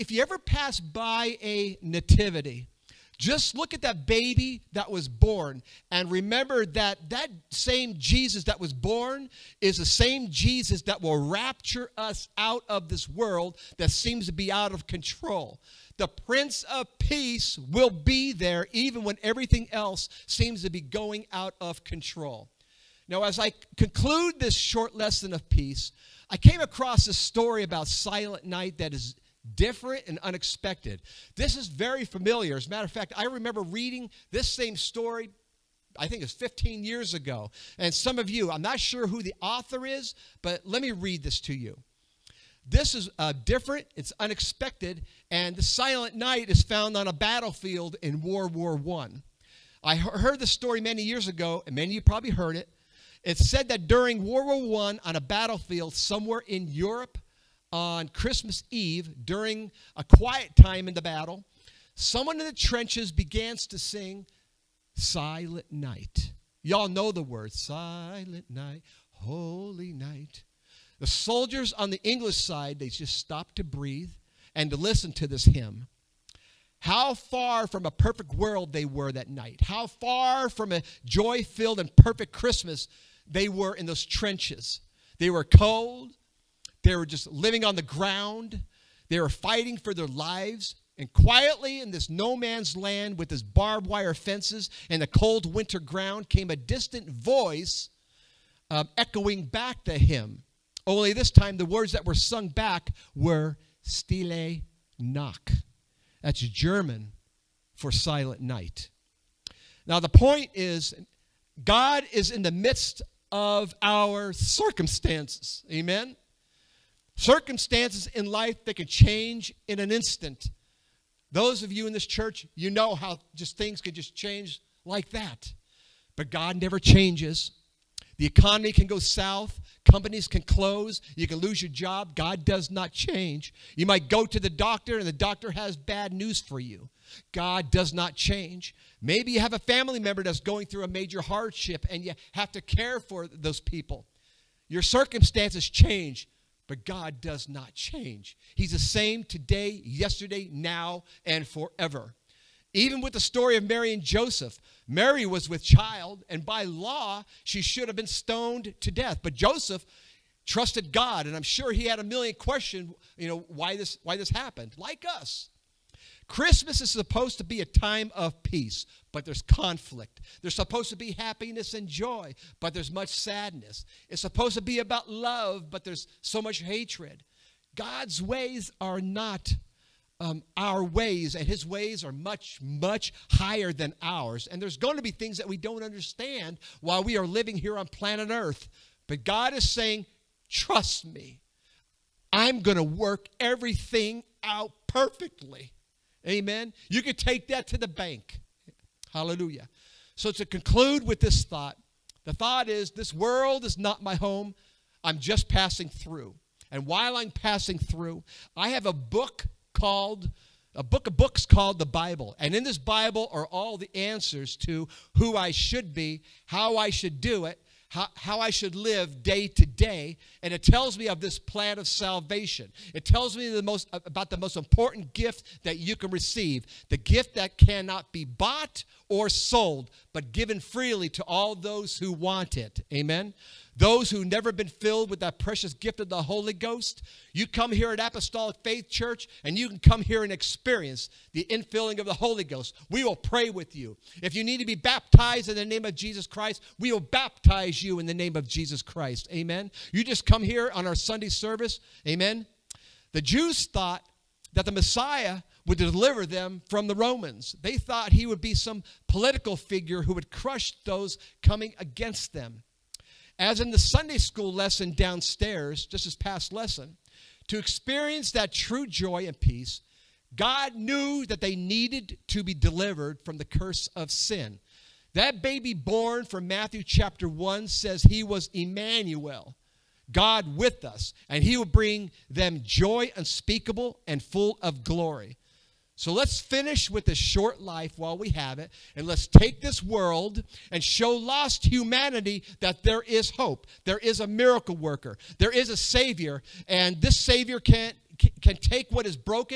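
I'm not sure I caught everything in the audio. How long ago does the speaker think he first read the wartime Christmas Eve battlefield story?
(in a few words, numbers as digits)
15 years ago.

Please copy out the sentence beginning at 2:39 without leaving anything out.
But Joseph trusted God, and I'm sure he had a million questions, you know, why this, why this happened, like us.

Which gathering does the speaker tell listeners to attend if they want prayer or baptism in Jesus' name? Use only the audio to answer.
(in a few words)
Sunday service.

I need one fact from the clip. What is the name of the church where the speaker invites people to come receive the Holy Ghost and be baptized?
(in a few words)
Apostolic Faith Church.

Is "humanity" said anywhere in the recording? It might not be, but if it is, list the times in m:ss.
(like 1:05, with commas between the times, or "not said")
4:51.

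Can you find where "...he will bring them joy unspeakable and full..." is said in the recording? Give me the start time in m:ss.
4:41.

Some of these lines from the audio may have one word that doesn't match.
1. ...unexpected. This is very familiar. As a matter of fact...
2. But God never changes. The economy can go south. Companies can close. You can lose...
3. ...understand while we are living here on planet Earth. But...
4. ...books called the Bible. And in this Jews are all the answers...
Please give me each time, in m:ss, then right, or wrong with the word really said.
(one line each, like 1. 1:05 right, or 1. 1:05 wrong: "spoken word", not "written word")
1. 0:30 right
2. 2:06 right
3. 3:05 right
4. 3:31 wrong: "Bible", not "Jews".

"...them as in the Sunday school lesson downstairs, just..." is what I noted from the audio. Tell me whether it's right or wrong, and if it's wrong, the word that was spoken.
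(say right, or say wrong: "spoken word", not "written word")
right.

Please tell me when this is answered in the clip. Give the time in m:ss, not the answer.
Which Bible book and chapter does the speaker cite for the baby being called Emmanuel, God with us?
4:36.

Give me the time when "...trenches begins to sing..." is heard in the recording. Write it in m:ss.
1:02.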